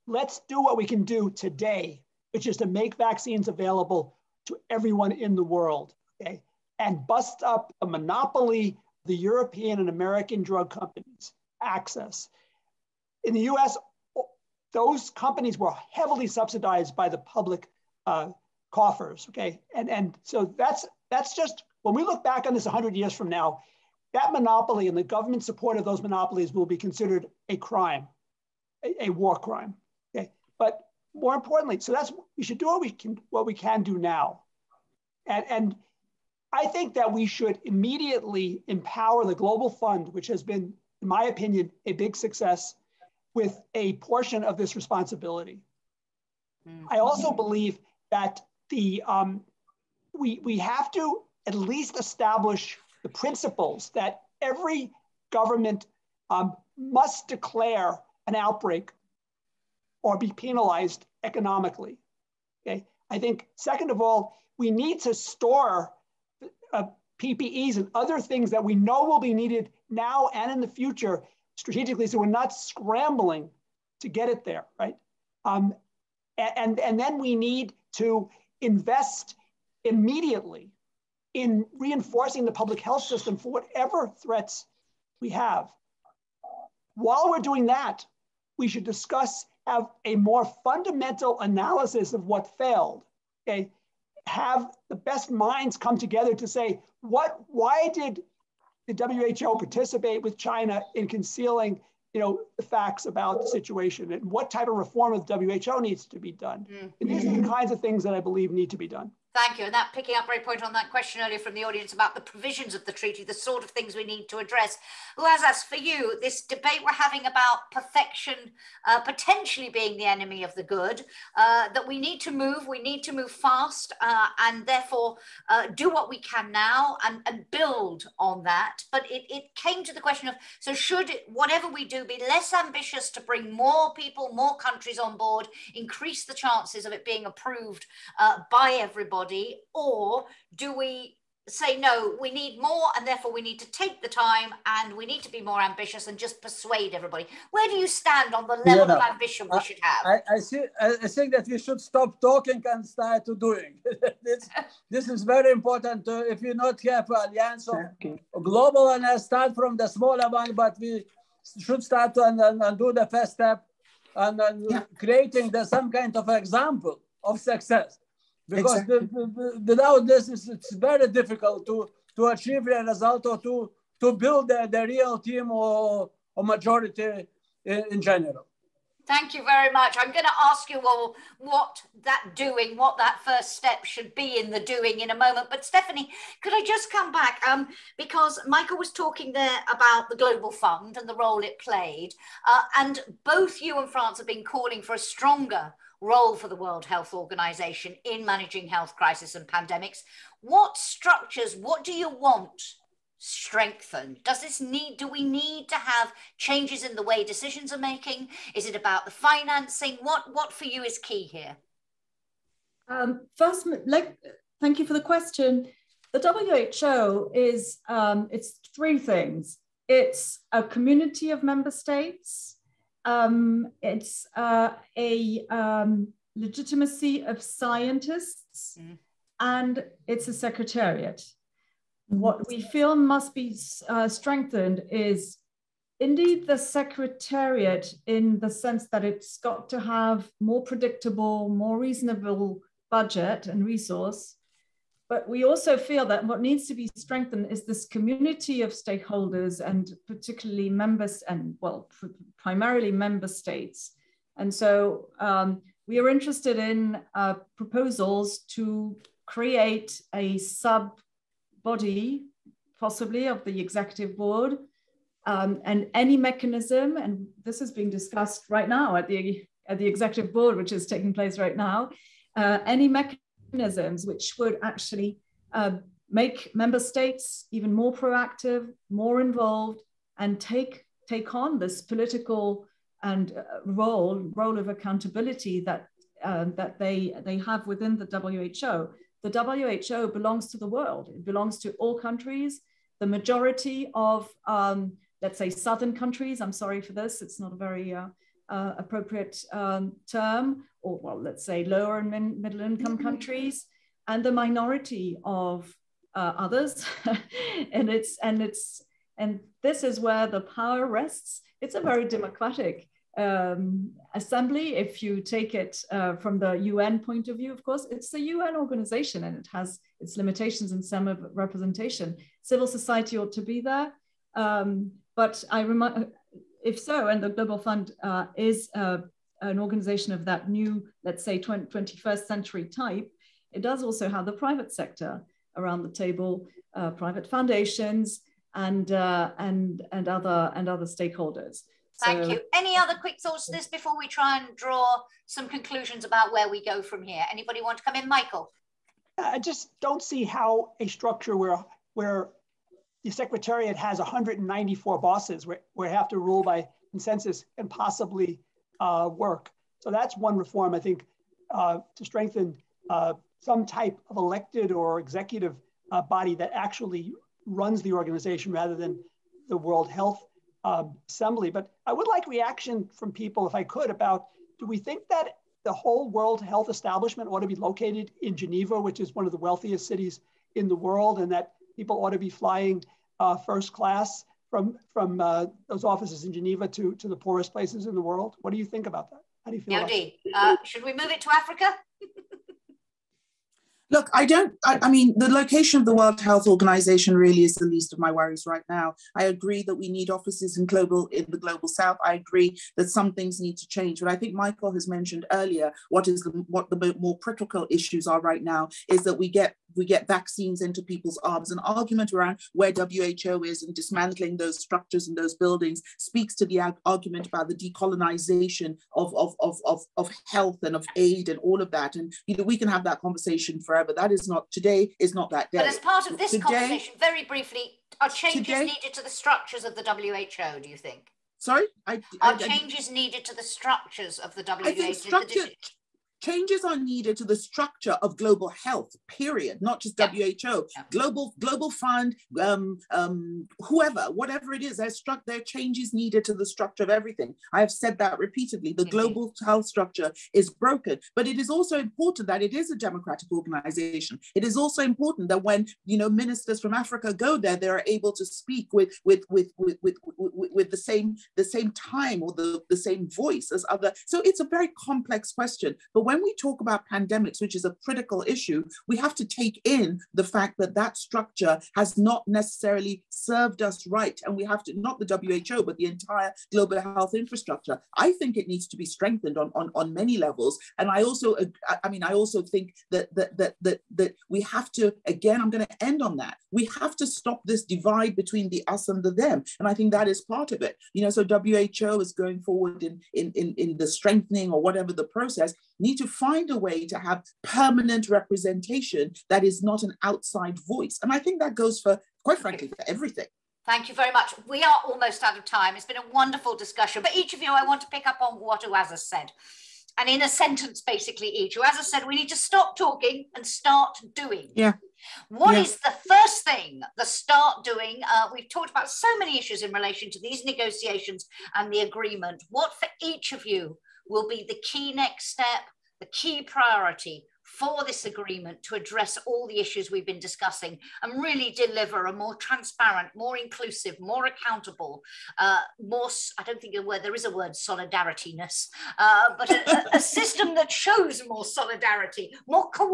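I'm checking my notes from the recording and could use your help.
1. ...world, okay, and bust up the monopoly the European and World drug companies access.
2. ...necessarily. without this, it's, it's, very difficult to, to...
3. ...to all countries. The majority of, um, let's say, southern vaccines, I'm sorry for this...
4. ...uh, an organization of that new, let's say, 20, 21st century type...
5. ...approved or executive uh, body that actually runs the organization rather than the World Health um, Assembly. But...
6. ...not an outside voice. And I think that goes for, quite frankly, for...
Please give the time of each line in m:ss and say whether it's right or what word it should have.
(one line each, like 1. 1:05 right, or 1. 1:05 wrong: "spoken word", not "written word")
1. 0:05 wrong: "American", not "World"
2. 2:48 wrong: "exactly", not "necessarily"
3. 4:51 wrong: "countries", not "vaccines"
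4. 5:28 right
5. 6:04 wrong: "elected", not "approved"
6. 8:19 right.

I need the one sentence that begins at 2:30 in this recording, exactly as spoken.
I, I, see, I think that we should stop talking and start to doing.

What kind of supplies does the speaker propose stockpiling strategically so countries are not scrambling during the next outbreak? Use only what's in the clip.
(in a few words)
PPEs.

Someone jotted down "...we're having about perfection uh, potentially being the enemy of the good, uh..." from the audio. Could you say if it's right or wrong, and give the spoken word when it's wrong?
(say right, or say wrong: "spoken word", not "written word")
right.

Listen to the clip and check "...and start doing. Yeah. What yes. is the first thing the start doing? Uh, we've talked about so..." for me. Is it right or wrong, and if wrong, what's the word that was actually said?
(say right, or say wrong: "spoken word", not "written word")
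right.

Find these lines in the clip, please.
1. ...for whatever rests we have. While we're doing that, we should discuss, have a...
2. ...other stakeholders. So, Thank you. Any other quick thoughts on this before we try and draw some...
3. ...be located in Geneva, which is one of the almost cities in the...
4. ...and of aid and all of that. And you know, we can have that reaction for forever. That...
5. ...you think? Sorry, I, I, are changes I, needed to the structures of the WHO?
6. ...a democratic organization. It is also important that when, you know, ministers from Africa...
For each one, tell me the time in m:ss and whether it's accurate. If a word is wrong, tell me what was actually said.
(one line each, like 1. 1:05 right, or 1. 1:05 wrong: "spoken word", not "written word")
1. 1:23 wrong: "threats", not "rests"
2. 5:40 right
3. 6:17 wrong: "wealthiest", not "almost"
4. 7:00 wrong: "conversation", not "reaction"
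5. 7:10 right
6. 7:32 right.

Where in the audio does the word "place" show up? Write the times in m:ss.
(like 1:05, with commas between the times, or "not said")
4:31, 6:27.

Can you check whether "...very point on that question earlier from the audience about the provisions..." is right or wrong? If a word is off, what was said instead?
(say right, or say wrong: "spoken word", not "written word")
right.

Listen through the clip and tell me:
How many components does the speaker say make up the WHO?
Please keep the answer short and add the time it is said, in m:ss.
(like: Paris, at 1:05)
3, at 3:38.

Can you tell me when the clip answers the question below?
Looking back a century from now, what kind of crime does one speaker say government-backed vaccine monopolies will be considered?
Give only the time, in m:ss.
0:29.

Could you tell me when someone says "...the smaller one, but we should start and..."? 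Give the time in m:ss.
2:39.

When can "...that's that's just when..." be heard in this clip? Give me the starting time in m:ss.
0:20.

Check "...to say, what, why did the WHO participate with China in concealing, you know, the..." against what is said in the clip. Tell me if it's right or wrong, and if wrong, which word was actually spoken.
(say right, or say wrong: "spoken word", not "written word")
right.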